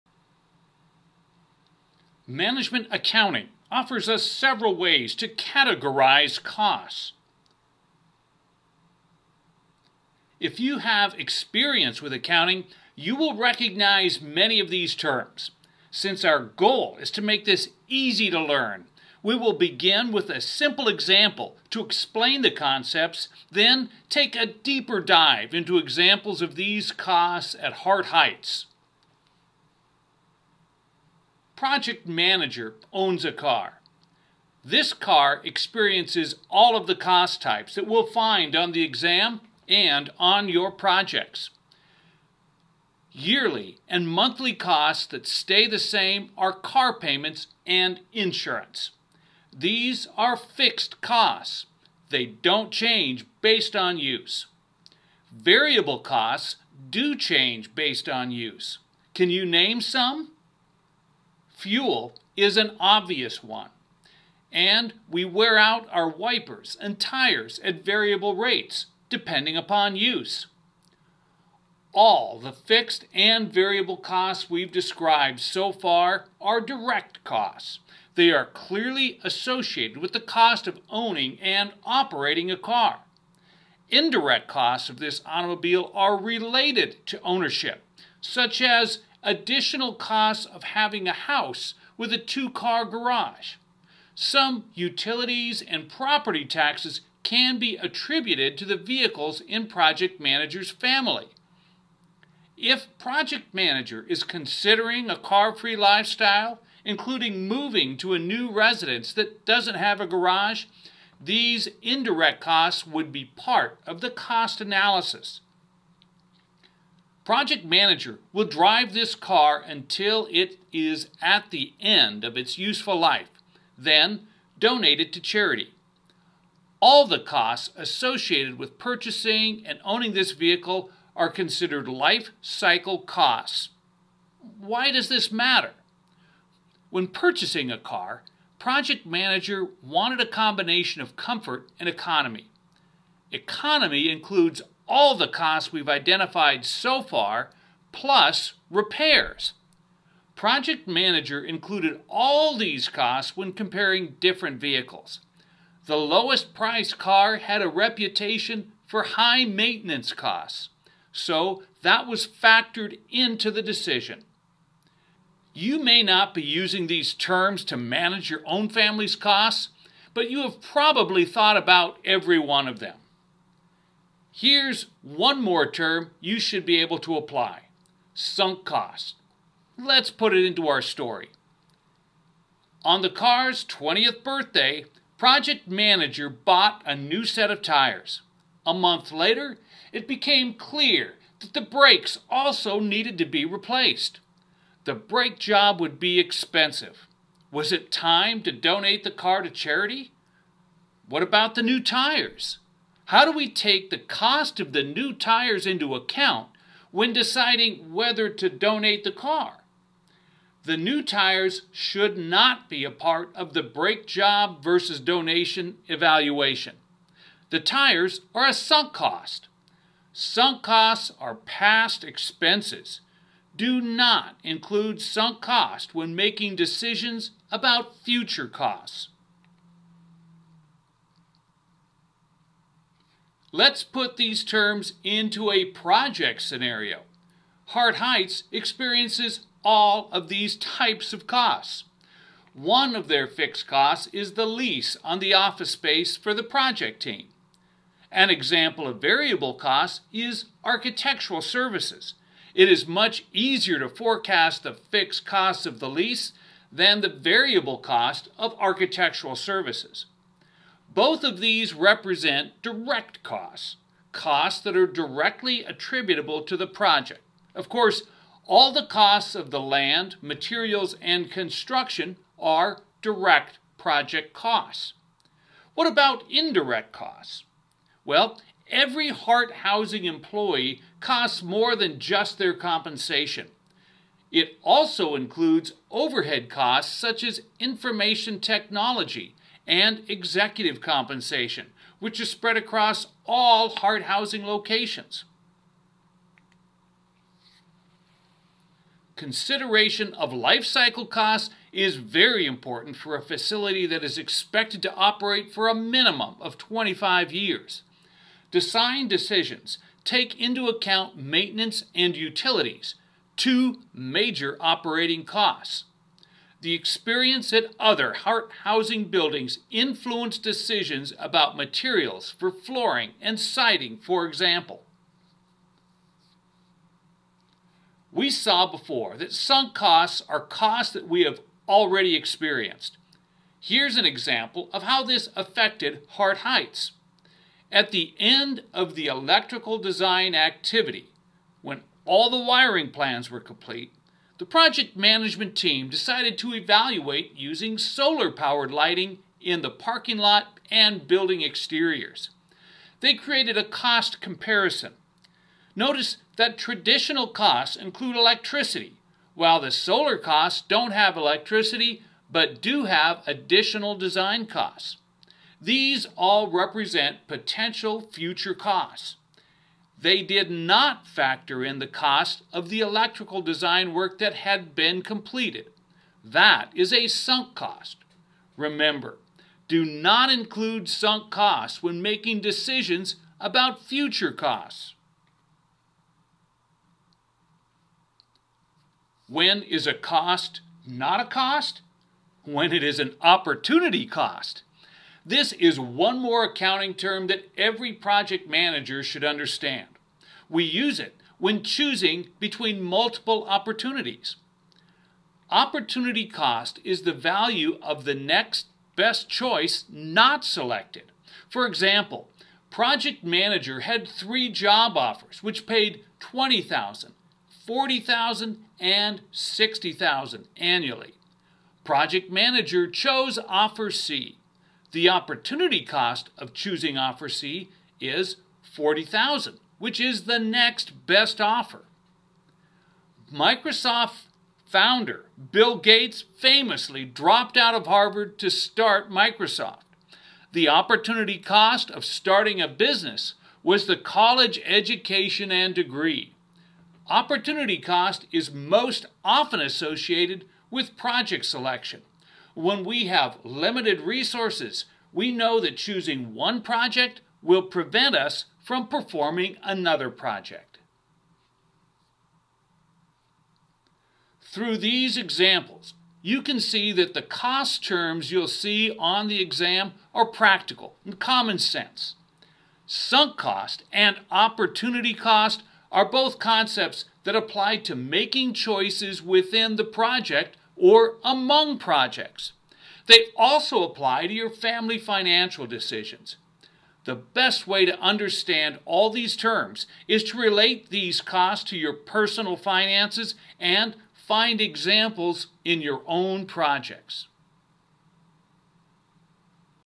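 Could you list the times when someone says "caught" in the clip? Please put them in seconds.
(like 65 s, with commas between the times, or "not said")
not said.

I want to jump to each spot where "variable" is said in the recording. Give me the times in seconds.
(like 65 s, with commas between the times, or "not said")
55 s, 67 s, 73 s, 249 s, 257 s.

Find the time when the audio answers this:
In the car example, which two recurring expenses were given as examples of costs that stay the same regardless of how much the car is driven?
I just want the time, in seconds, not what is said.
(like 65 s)
46 s.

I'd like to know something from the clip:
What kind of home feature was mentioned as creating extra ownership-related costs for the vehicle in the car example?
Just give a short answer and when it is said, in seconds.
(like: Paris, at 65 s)
two car garage, at 92 s.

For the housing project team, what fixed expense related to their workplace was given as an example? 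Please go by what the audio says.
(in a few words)
lease on the office space.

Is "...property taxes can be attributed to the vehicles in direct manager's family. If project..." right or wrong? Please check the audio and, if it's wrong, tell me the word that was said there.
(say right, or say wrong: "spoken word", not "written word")
wrong: "project", not "direct".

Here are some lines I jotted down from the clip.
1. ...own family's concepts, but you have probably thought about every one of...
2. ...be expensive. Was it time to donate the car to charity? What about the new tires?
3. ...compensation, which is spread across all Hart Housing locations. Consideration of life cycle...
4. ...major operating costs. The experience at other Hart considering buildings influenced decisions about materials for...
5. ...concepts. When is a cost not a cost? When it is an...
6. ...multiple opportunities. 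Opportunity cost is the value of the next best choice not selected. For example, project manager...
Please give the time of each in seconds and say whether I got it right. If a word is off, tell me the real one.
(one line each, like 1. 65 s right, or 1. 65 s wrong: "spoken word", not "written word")
1. 168 s wrong: "costs", not "concepts"
2. 195 s right
3. 290 s right
4. 313 s wrong: "housing", not "considering"
5. 384 s wrong: "costs", not "concepts"
6. 402 s right.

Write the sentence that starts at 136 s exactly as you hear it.
When purchasing a car, Project Manager wanted a combination of comfort and economy.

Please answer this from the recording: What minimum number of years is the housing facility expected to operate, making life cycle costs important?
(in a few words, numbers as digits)
25.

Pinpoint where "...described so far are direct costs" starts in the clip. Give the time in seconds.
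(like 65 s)
74 s.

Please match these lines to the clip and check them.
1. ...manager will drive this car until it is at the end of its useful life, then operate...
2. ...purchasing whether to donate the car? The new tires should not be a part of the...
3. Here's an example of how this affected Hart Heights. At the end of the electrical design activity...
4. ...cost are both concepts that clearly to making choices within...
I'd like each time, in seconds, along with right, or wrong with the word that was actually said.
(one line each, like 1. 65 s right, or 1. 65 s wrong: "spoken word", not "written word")
1. 117 s wrong: "donate", not "operate"
2. 207 s wrong: "deciding", not "purchasing"
3. 333 s right
4. 475 s wrong: "apply", not "clearly".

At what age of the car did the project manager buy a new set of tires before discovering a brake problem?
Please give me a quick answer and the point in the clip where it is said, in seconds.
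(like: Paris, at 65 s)
20th birthday, at 183 s.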